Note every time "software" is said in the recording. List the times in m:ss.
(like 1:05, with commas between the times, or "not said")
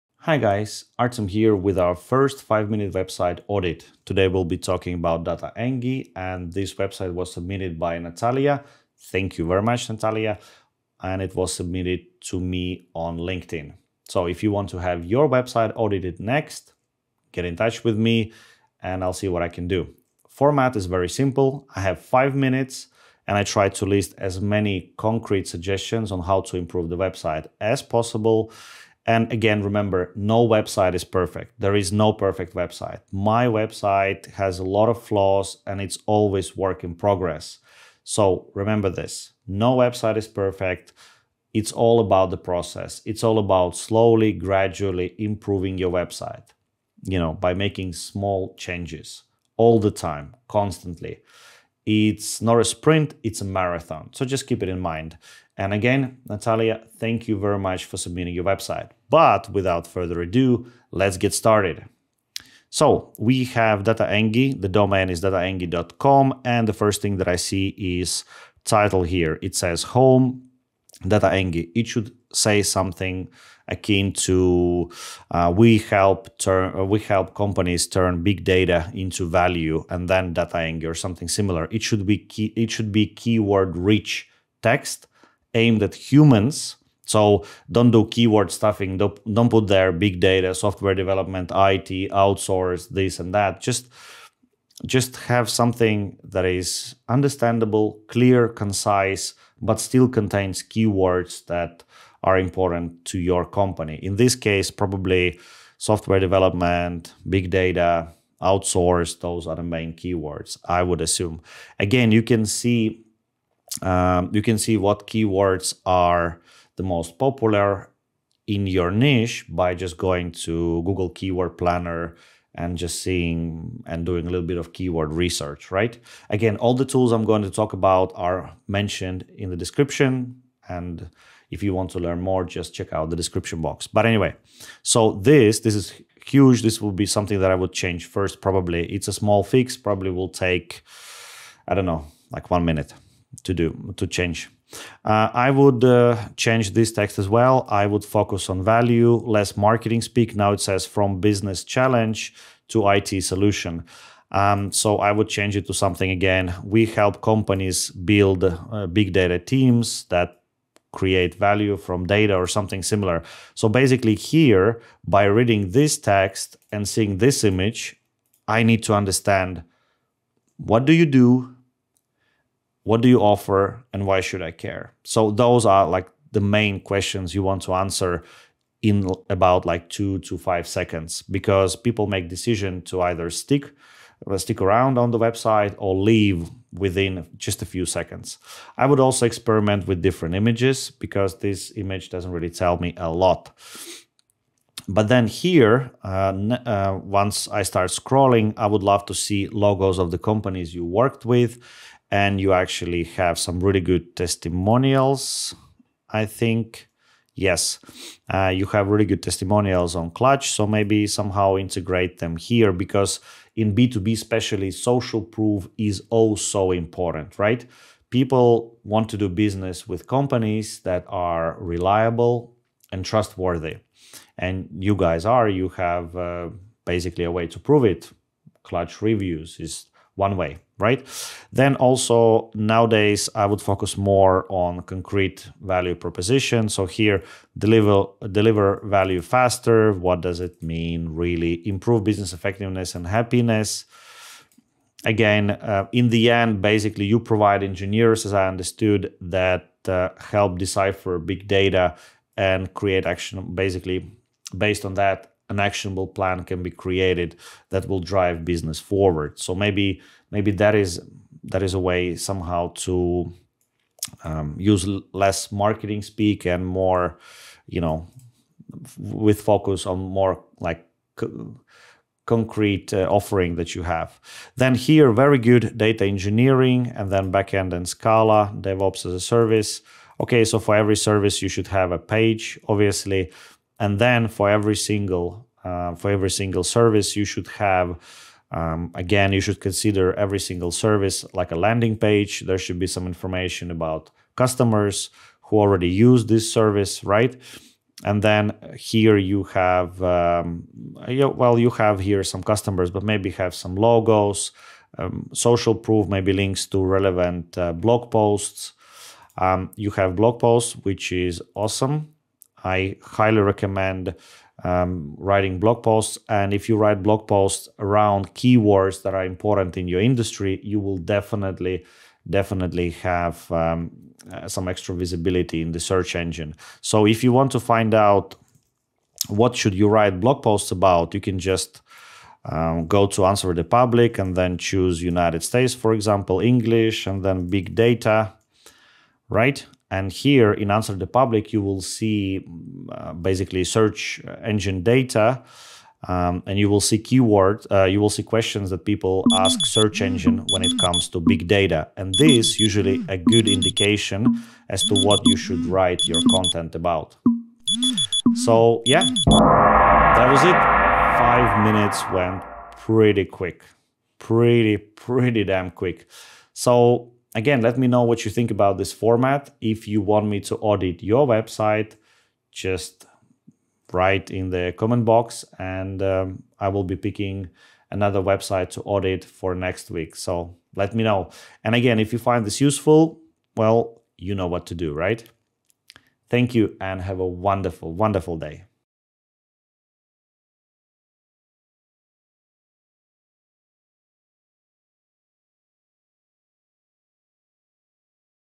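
1:30, 1:45.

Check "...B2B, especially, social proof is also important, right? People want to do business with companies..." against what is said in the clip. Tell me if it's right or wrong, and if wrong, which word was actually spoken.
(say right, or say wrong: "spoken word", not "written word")
right.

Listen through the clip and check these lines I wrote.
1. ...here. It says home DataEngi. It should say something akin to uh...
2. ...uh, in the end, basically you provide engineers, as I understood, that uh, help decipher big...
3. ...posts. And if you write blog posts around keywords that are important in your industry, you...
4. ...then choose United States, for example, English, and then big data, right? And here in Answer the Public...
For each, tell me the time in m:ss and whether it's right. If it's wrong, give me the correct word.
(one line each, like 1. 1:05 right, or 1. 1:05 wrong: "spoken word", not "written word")
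1. 1:09 right
2. 4:05 right
3. 5:15 right
4. 5:34 right.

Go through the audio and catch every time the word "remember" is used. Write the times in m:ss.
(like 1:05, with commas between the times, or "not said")
0:29, 0:38.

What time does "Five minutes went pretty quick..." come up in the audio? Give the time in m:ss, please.
6:01.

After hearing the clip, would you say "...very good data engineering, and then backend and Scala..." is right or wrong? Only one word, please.
right.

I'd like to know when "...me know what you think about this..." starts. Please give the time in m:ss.
6:07.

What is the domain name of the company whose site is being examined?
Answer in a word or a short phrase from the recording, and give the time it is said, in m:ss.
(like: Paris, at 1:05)
dataengi.com, at 1:05.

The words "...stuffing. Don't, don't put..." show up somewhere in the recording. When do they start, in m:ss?
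1:28.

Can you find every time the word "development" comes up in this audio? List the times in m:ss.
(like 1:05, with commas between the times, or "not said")
1:30, 1:46.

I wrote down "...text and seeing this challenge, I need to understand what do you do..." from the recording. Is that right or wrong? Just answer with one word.
wrong.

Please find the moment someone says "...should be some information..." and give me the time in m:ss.
4:52.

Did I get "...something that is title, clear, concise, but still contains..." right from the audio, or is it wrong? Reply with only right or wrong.
wrong.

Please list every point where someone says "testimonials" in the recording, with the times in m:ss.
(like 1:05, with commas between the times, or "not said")
3:24, 3:29.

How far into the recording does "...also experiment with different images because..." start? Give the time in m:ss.
3:08.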